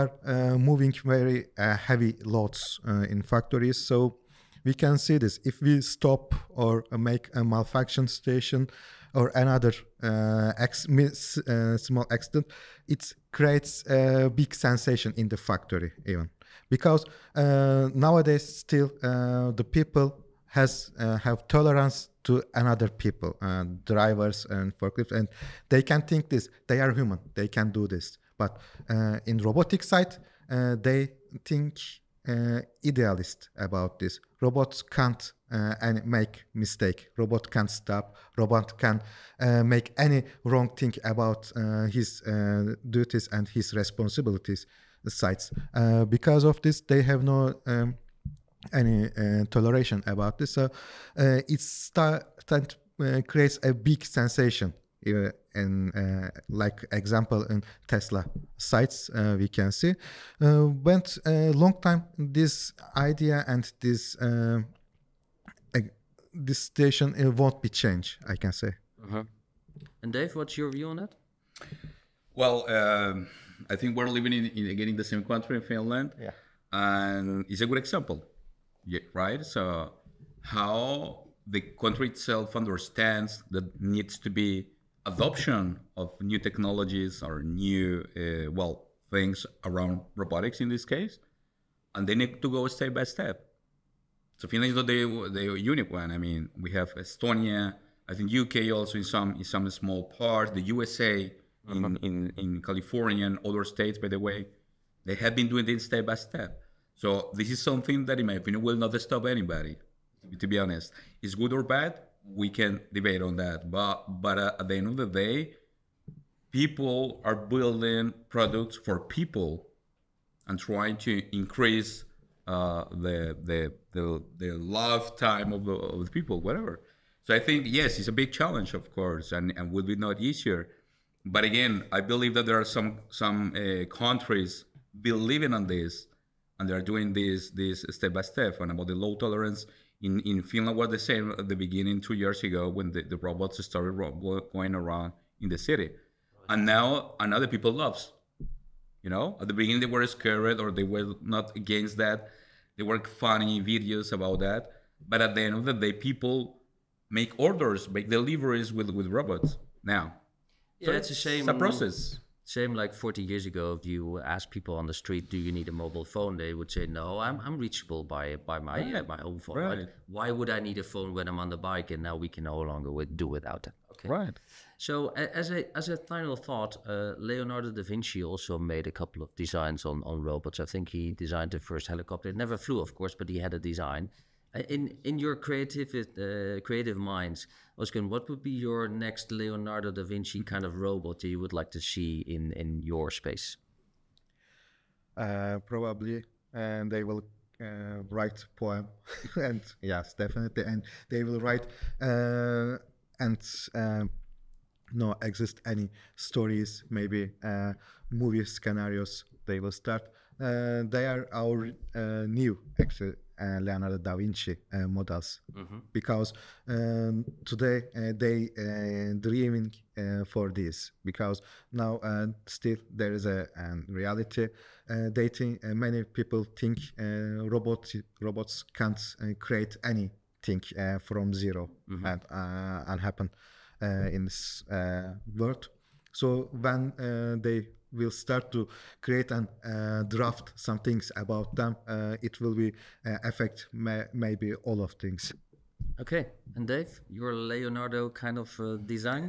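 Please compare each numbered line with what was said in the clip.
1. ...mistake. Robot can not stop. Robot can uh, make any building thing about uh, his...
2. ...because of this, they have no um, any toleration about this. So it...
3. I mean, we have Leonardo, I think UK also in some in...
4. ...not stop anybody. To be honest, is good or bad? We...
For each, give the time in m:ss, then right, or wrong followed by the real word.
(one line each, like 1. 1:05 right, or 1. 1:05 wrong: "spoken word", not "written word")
1. 0:36 wrong: "wrong", not "building"
2. 0:46 right
3. 1:36 wrong: "Estonia", not "Leonardo"
4. 1:48 right.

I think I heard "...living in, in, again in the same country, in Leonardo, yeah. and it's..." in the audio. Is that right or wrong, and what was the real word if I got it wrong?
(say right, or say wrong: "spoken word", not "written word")
wrong: "Finland", not "Leonardo".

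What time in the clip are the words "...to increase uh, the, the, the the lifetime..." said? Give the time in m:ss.
2:00.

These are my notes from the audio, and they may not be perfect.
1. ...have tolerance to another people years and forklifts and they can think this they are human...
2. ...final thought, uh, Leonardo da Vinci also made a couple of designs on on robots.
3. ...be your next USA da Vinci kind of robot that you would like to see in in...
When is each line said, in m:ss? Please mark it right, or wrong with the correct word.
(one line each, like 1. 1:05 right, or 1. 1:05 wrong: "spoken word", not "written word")
1. 0:21 wrong: "drivers", not "years"
2. 2:55 right
3. 3:08 wrong: "Leonardo", not "USA".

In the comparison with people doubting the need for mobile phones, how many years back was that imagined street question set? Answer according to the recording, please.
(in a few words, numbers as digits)
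40 years.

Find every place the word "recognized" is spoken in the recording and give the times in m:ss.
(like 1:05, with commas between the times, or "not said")
not said.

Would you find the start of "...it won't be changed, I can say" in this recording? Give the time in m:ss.
1:07.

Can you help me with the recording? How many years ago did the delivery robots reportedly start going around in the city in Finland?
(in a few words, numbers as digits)
2 years.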